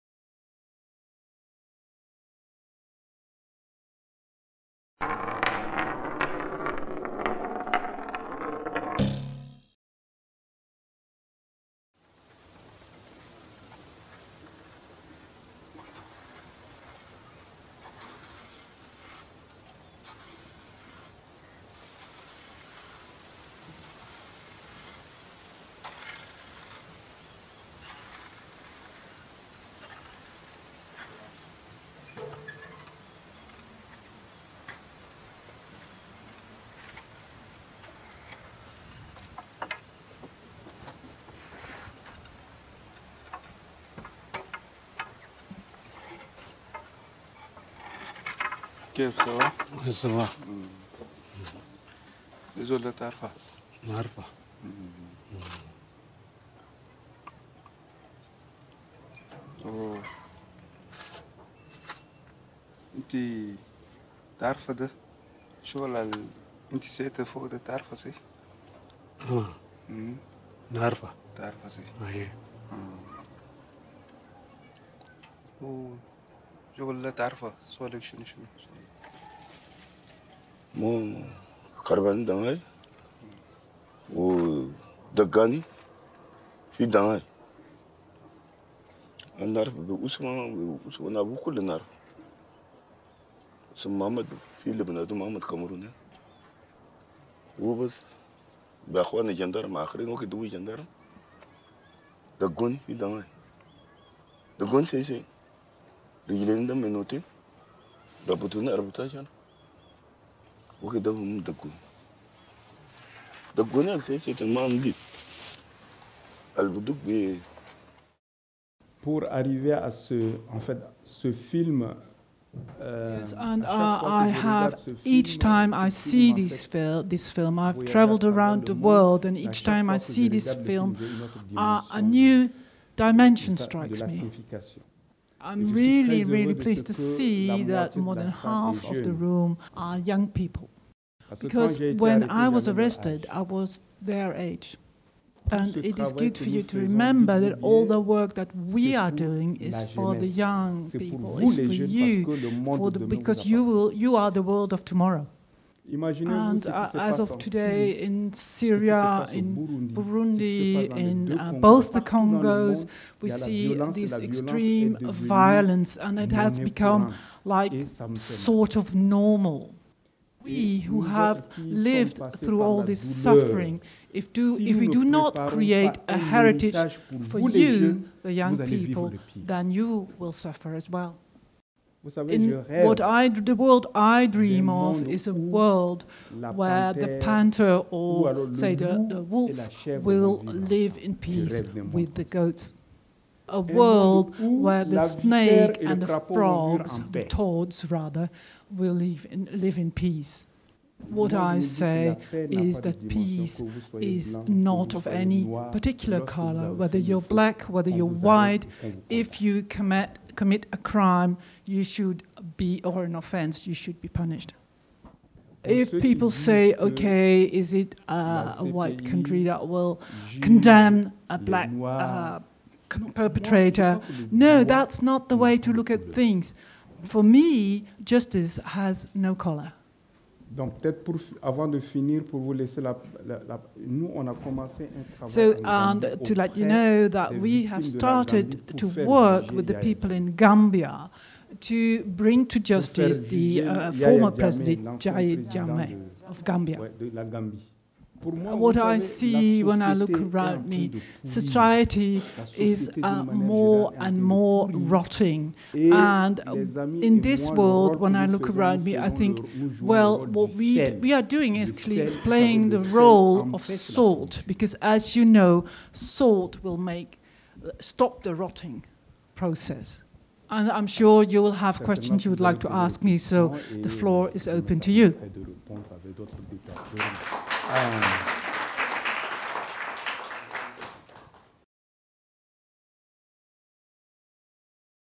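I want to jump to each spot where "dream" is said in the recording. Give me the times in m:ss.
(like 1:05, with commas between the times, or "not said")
3:04.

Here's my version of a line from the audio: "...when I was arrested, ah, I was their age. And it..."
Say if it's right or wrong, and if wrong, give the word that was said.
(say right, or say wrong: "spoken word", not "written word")
right.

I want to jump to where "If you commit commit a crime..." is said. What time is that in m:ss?
3:29.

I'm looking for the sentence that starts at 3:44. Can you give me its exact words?
No, that's not the way to look at things.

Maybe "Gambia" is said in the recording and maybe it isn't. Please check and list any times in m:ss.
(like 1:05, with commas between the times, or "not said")
4:00, 4:06.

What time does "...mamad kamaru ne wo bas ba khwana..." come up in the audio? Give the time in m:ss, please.
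1:35.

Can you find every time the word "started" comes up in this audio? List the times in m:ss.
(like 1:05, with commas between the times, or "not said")
3:57.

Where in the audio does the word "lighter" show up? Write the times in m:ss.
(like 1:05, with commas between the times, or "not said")
not said.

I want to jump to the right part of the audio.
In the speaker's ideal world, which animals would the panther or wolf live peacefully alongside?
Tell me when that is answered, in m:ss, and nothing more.
3:12.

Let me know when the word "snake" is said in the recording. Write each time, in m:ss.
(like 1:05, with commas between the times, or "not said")
3:15.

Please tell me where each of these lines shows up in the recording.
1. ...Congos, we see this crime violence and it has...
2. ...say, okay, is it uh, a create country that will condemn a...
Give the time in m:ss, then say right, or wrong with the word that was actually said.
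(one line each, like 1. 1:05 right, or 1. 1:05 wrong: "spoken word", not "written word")
1. 2:42 wrong: "extreme", not "crime"
2. 3:36 wrong: "white", not "create".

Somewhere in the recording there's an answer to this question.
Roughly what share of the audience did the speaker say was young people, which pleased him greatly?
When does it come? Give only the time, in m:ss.
2:17.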